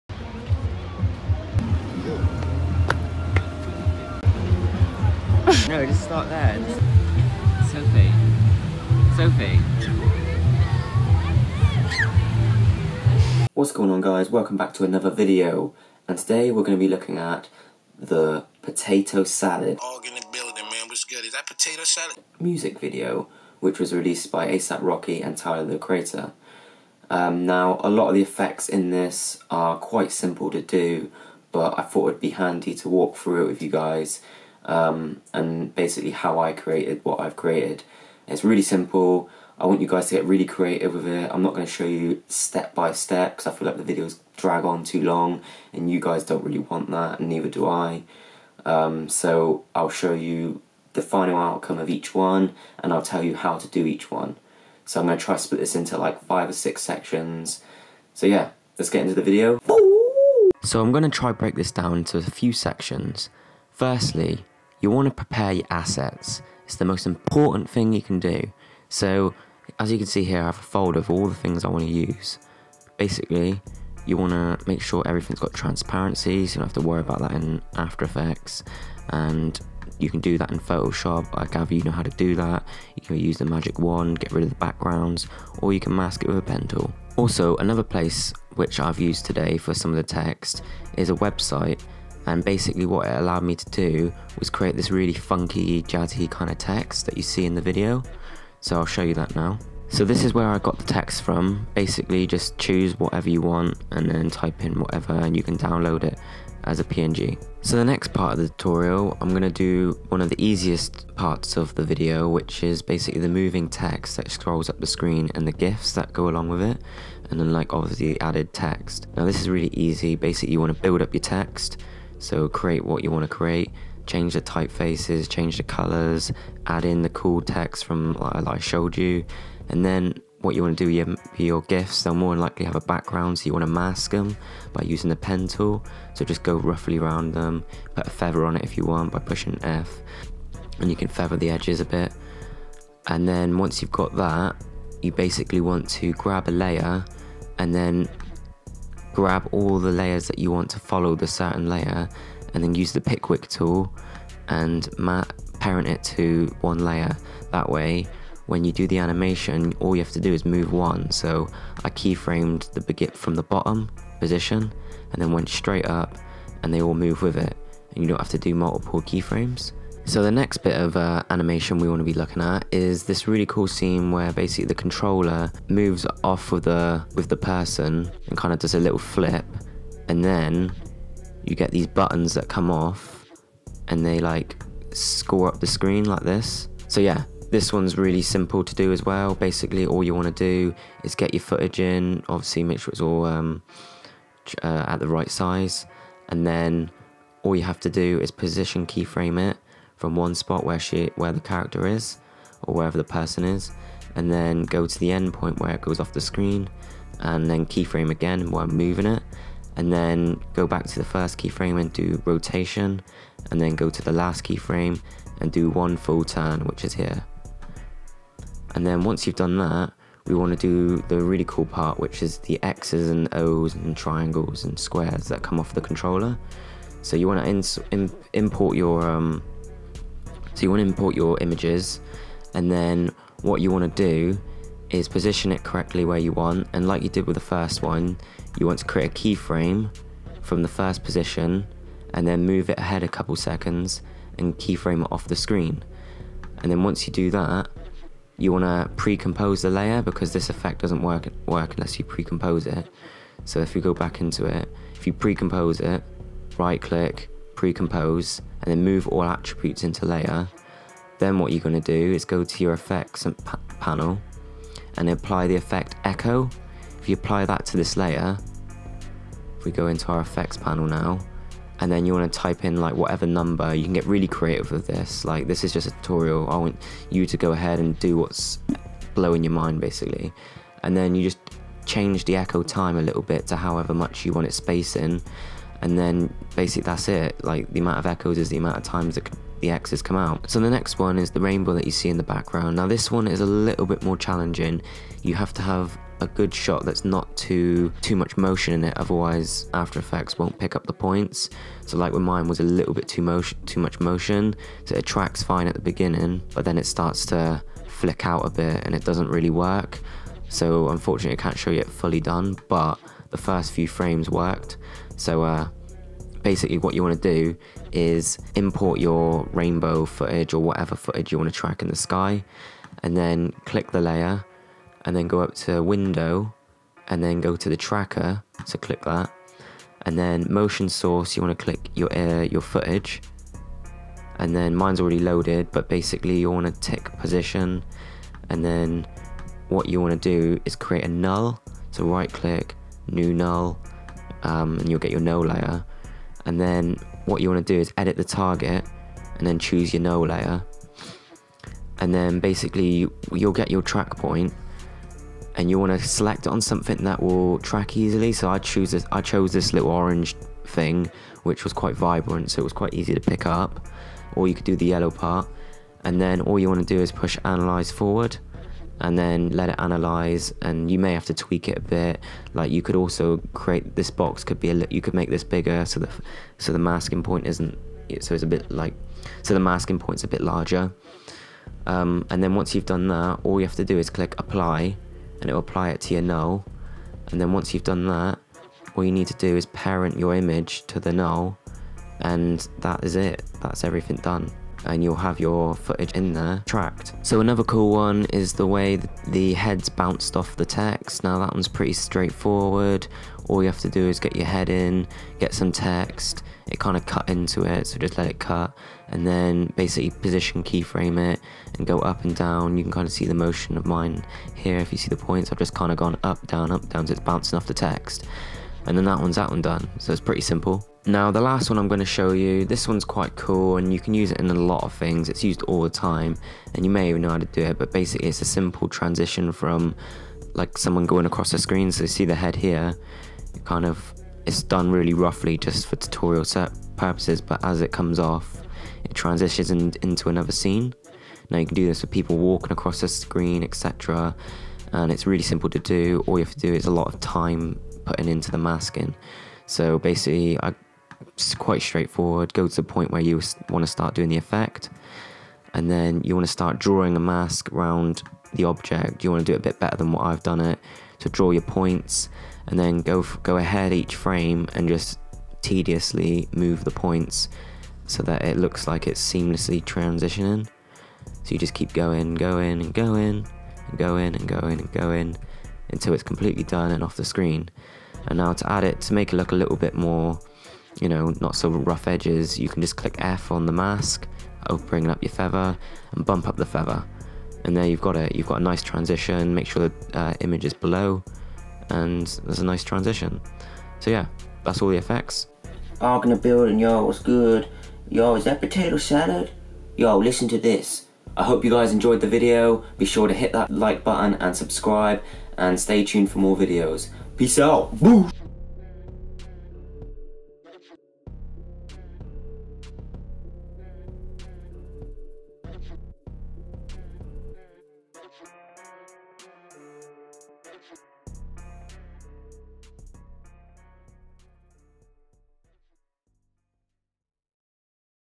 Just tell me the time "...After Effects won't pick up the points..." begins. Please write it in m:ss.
4:59.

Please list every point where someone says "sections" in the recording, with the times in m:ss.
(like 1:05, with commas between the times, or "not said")
0:56, 1:02.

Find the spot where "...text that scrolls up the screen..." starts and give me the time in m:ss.
1:53.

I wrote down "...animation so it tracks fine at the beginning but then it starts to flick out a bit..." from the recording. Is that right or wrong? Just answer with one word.
wrong.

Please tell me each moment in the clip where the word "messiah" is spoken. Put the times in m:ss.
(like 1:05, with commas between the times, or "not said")
not said.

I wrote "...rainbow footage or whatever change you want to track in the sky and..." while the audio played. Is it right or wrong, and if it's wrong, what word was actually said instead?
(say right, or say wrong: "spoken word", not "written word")
wrong: "footage", not "change".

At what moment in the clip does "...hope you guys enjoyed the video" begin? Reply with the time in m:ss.
8:21.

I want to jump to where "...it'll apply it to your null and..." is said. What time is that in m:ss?
6:25.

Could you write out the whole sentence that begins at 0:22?
Music video, which was released by ASAP Rocky and Tyler the Creator.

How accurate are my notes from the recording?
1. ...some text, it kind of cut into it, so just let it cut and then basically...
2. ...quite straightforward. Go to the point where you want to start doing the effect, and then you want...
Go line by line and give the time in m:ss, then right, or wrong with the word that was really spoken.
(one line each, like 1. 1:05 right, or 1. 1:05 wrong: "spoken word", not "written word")
1. 6:45 right
2. 7:31 right.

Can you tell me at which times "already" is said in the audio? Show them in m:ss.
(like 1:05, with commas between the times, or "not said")
5:35.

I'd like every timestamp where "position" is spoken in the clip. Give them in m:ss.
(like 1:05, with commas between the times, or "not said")
2:44, 3:18, 3:55, 4:01, 5:37, 6:50.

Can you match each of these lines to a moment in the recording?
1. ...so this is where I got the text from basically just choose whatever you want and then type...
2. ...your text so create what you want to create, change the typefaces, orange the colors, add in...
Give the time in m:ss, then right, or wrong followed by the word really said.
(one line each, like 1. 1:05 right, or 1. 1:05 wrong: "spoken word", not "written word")
1. 1:39 right
2. 2:01 wrong: "change", not "orange".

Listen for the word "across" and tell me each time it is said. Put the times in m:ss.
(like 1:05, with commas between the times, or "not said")
7:11, 7:22.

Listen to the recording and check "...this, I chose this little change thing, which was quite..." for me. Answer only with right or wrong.
wrong.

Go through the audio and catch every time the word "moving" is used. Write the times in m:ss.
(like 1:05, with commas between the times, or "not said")
1:53, 3:28.